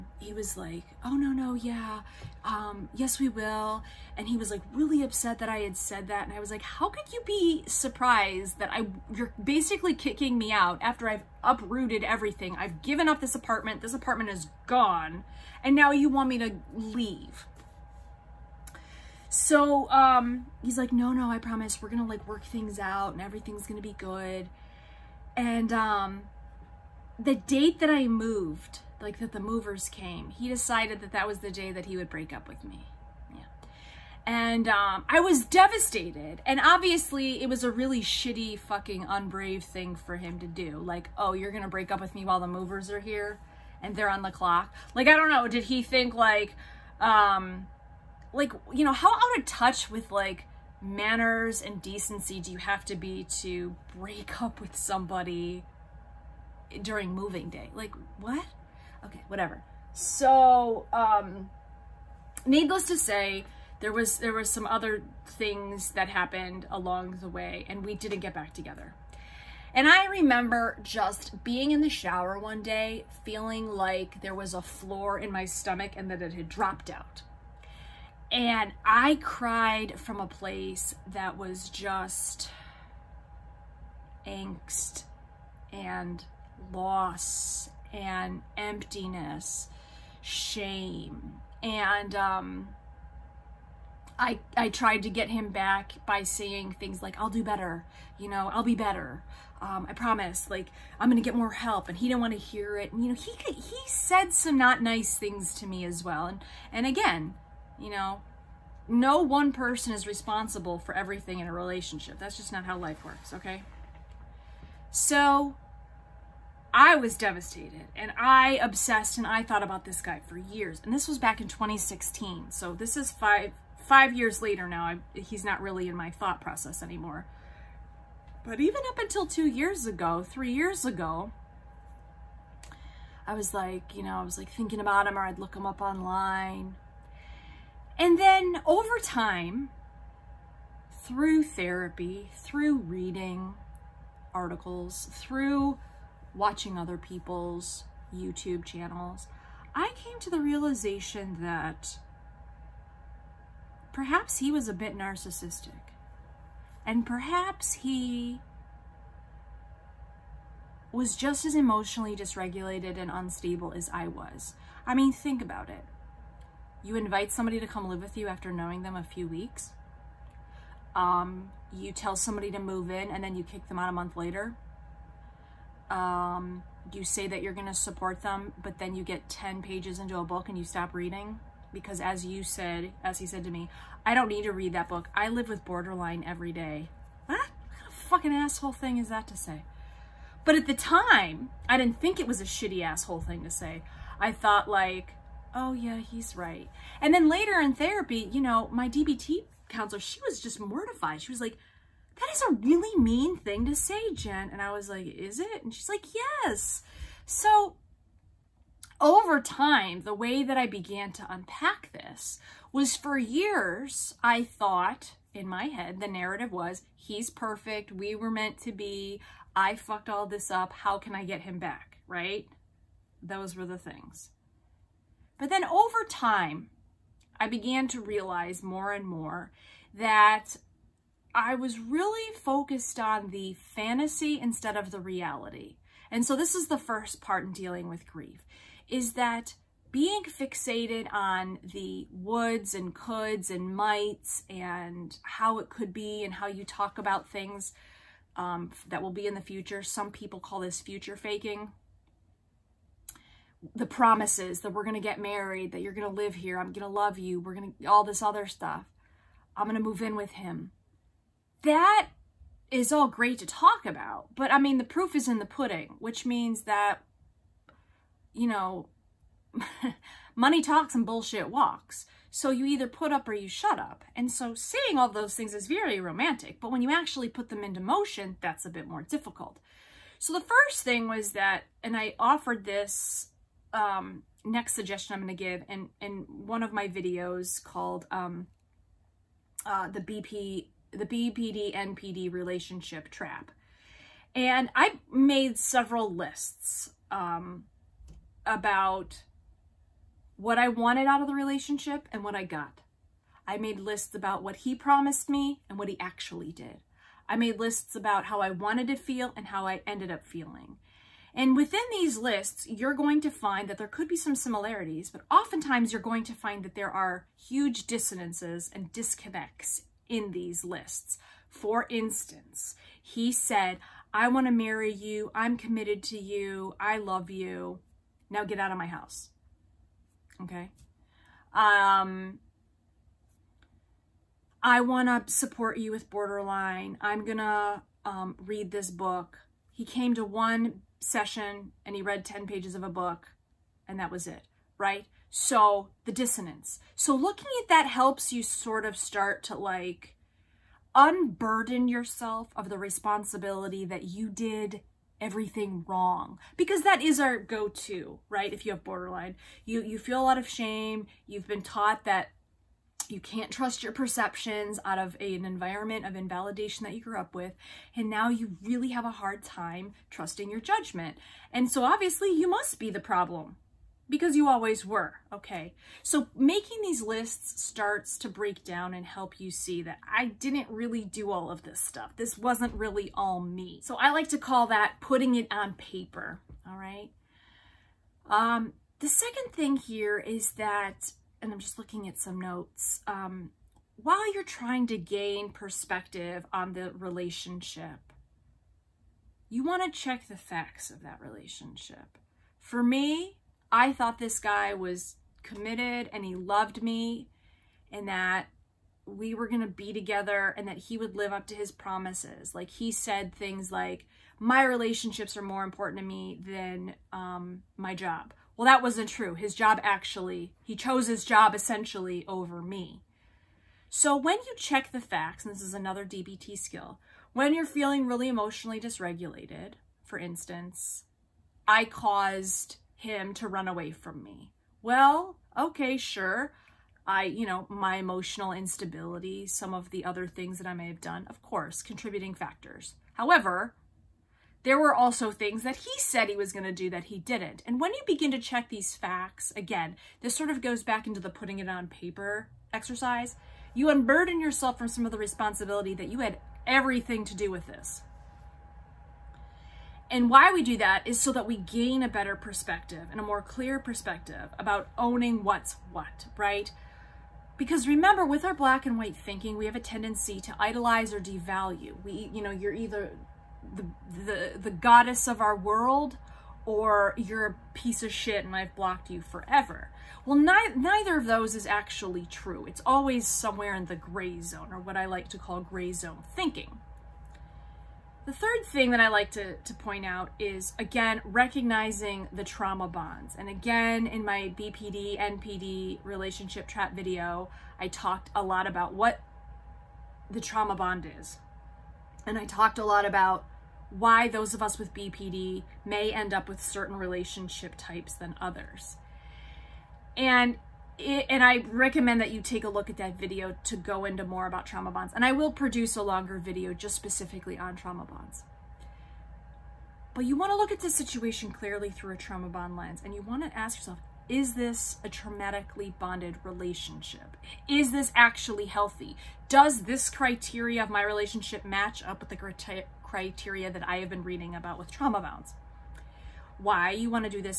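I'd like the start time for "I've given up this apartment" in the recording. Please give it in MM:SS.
00:12.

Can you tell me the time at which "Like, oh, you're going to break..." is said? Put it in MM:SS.
00:40.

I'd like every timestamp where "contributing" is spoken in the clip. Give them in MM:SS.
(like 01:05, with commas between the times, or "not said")
07:21.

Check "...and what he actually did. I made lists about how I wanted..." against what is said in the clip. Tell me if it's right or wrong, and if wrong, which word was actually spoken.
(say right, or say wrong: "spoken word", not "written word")
right.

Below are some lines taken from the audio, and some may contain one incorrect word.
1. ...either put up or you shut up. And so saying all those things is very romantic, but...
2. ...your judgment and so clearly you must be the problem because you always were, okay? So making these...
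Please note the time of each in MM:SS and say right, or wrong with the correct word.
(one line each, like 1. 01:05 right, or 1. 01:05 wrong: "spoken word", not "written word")
1. 04:32 right
2. 06:10 wrong: "obviously", not "clearly".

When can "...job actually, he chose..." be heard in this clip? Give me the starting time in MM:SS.
06:59.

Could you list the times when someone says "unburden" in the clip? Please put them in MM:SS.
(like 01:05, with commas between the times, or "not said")
05:50, 07:33.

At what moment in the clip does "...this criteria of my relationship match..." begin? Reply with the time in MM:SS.
08:49.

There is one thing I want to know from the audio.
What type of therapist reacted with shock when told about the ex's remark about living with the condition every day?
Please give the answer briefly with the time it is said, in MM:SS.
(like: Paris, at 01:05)
DBT counselor, at 03:18.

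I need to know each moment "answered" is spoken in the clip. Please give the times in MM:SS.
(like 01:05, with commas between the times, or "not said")
not said.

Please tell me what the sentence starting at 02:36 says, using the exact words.
And perhaps he was just as emotionally dysregulated and unstable as I was.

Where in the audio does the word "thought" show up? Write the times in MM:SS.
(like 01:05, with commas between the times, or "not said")
01:59, 02:06, 03:14, 03:34, 06:43.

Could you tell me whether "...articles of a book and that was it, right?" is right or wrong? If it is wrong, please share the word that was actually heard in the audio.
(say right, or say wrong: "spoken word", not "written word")
wrong: "pages", not "articles".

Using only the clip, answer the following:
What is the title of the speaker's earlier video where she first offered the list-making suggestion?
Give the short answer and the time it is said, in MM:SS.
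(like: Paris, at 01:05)
The BPD NPD relationship trap, at 04:50.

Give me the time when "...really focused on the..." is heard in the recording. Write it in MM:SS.
03:51.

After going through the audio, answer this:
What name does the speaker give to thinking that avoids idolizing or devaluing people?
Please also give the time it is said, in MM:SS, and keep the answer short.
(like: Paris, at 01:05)
Gray zone thinking, at 08:05.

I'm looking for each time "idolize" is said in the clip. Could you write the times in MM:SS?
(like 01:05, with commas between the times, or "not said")
07:50.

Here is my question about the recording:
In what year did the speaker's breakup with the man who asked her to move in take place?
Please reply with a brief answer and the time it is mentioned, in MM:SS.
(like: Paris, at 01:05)
2016, at 02:01.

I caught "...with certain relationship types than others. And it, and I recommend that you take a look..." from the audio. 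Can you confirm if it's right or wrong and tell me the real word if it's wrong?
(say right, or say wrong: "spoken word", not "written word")
right.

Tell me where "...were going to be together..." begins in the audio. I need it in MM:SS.
06:49.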